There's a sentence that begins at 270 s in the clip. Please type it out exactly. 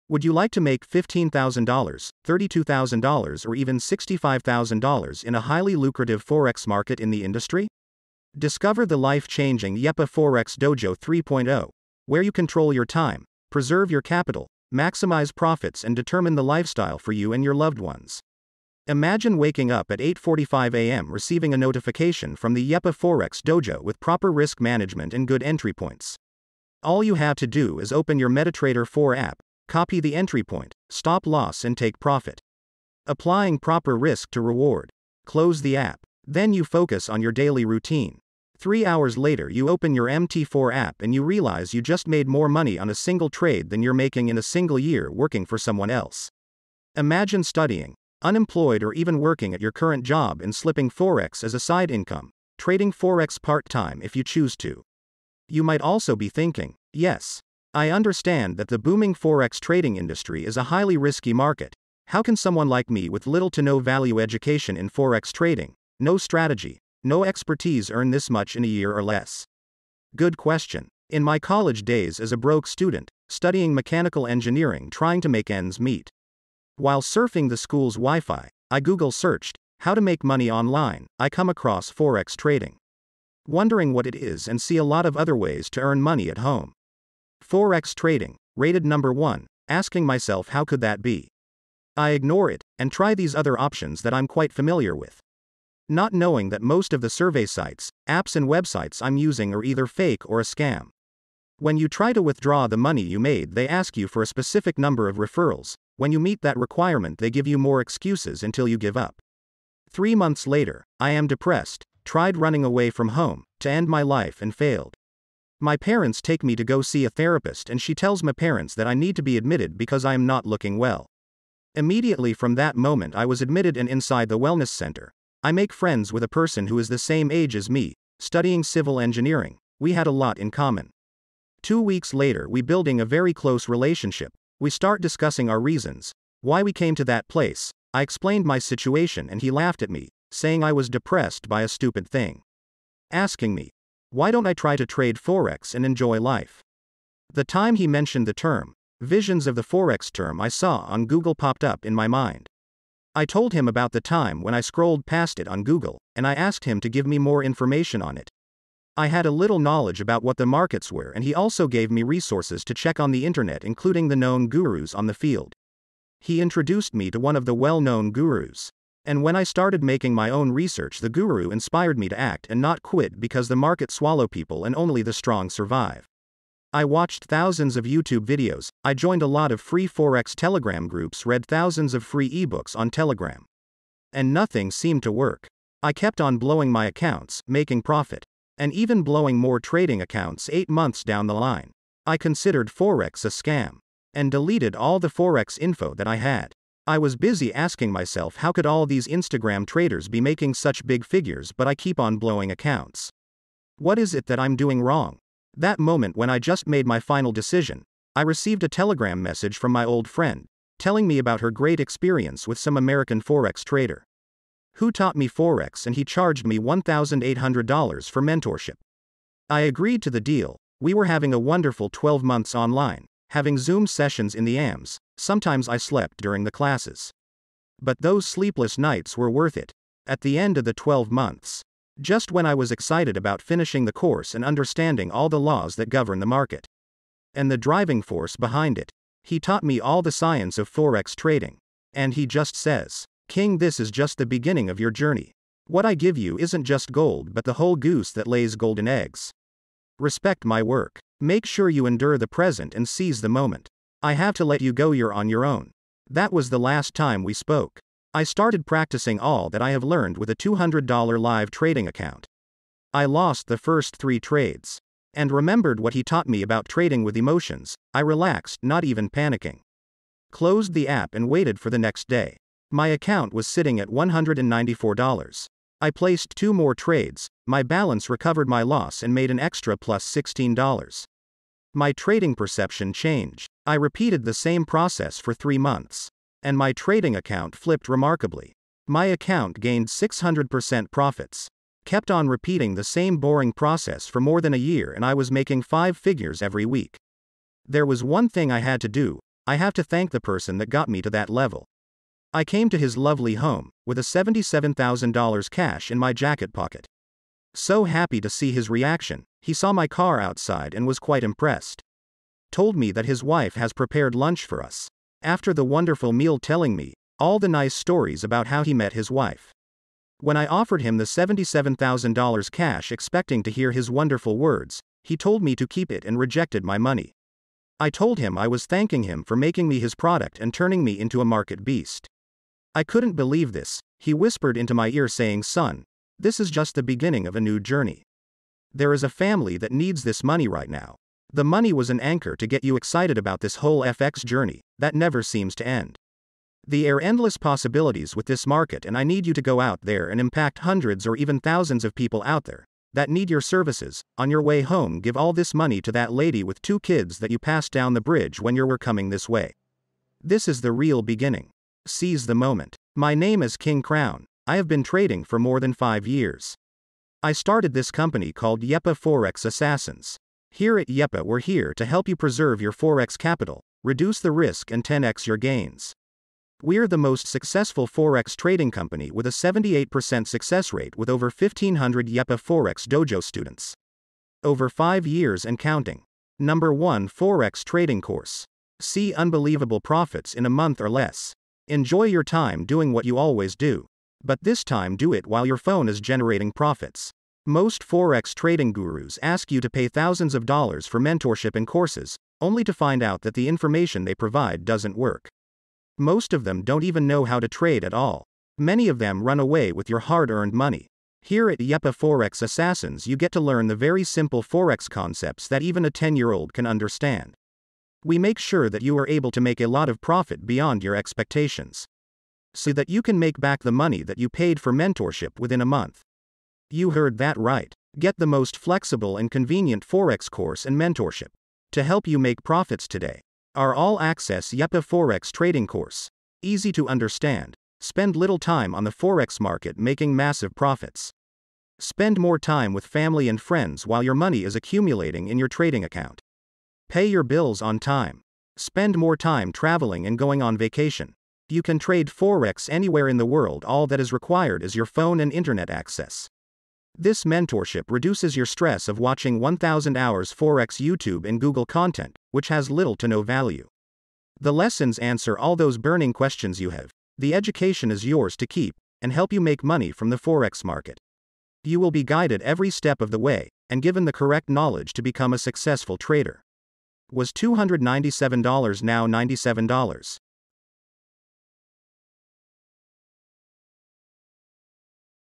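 Closed the app and waited for the next day.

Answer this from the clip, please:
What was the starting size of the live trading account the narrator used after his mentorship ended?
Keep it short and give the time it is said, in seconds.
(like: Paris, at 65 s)
$200, at 260 s.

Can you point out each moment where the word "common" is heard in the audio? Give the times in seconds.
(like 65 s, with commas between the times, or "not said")
130 s.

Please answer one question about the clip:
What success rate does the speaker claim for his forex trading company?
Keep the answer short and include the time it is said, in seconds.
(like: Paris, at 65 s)
78%, at 379 s.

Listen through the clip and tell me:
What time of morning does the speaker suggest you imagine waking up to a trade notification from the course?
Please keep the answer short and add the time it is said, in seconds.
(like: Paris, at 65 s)
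8:45 a.m., at 20 s.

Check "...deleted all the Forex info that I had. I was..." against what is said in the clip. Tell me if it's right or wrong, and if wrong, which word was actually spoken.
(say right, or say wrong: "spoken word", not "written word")
right.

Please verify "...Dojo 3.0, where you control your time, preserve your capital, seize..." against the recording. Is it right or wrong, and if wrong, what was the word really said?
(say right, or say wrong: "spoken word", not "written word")
wrong: "maximize", not "seize".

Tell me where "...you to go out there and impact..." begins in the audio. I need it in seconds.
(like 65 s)
349 s.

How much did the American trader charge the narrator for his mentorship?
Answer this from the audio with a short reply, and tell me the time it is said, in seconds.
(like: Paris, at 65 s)
$1,800, at 216 s.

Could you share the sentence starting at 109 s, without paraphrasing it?
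Three months later, I am depressed, tried running away from home to end my life and failed.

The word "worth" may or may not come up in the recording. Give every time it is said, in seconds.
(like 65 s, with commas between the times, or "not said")
229 s.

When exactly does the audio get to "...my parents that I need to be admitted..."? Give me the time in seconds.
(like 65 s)
118 s.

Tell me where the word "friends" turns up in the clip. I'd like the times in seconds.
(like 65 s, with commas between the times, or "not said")
125 s, 210 s, 443 s.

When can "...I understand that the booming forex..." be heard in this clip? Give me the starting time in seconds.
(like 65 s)
57 s.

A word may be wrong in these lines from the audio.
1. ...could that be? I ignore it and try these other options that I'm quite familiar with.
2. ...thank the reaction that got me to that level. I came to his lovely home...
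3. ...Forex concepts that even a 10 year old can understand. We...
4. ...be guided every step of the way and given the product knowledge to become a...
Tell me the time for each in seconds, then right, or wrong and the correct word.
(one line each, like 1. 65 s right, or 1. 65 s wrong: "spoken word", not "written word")
1. 90 s right
2. 299 s wrong: "person", not "reaction"
3. 414 s right
4. 471 s wrong: "correct", not "product".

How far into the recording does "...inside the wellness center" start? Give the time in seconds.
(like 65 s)
123 s.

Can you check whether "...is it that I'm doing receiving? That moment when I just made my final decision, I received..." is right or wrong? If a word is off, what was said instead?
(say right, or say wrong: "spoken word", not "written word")
wrong: "wrong", not "receiving".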